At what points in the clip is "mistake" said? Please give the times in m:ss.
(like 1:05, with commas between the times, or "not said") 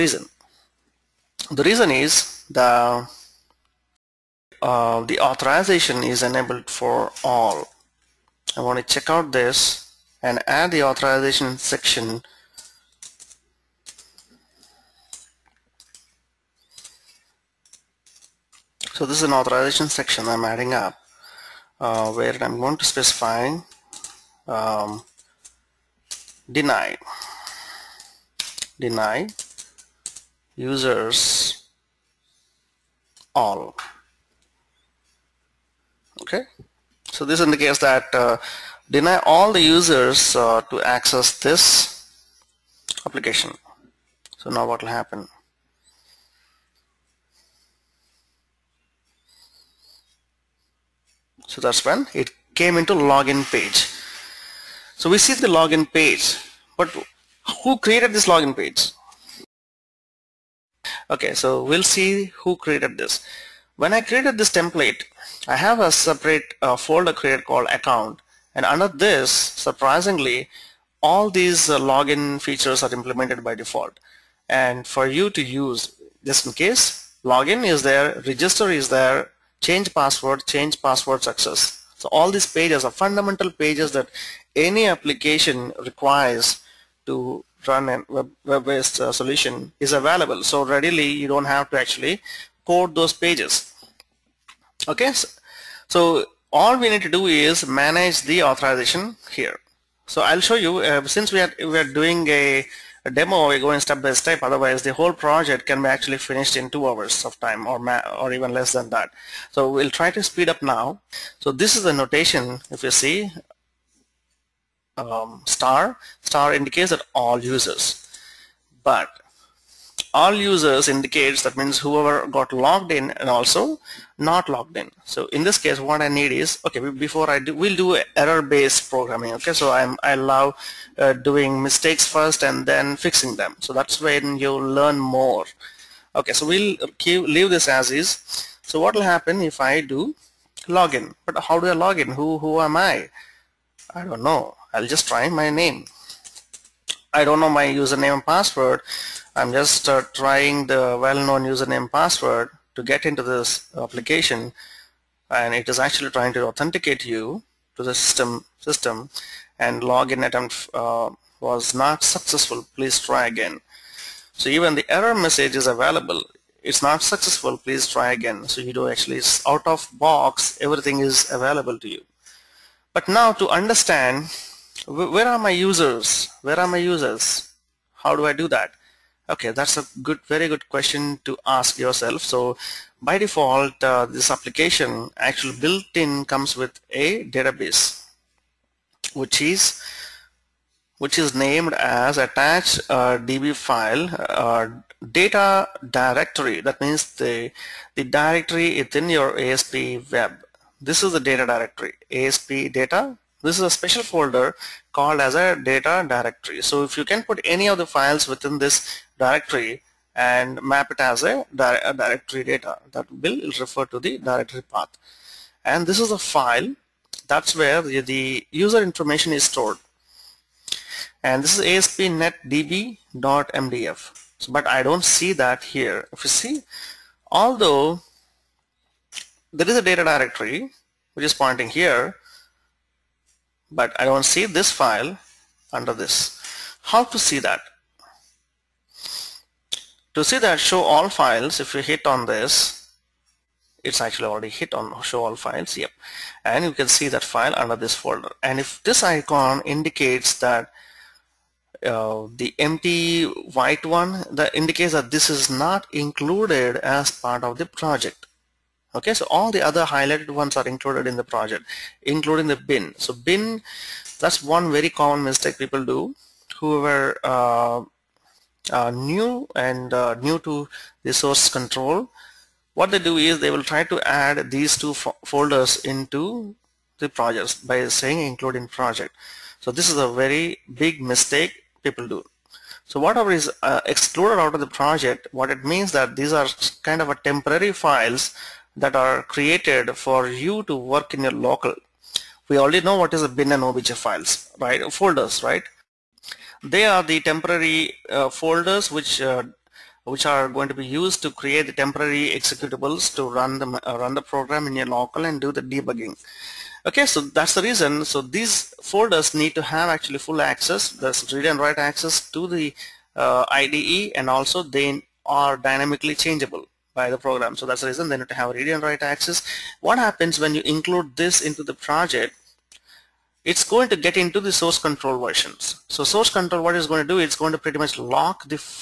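2:11, 4:25, 4:41.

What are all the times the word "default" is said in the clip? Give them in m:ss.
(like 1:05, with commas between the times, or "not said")
1:13, 3:03.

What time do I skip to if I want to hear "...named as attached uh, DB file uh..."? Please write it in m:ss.
3:11.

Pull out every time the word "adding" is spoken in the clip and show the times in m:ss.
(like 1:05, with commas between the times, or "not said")
0:20.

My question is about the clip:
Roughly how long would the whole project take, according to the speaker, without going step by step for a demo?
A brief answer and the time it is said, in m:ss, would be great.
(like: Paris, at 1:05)
2 hours, at 1:46.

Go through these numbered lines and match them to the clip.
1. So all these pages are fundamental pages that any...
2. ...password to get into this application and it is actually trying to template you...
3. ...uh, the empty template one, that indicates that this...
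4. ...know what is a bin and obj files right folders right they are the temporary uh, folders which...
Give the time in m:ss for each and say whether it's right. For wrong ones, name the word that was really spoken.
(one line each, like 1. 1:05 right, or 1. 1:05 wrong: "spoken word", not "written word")
1. 1:21 right
2. 2:31 wrong: "authenticate", not "template"
3. 4:11 wrong: "white", not "template"
4. 4:52 right.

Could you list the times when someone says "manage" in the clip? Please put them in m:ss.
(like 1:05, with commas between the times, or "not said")
1:37.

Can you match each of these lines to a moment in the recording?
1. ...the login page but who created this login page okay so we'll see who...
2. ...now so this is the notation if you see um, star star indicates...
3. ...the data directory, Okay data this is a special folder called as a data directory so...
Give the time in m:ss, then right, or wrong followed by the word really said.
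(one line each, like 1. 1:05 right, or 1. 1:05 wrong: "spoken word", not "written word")
1. 0:55 right
2. 1:50 right
3. 3:21 wrong: "ASP", not "Okay".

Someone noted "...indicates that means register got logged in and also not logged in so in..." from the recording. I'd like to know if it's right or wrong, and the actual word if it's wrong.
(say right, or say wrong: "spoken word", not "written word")
wrong: "whoever", not "register".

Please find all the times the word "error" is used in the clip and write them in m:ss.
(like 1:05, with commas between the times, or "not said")
2:08, 2:44.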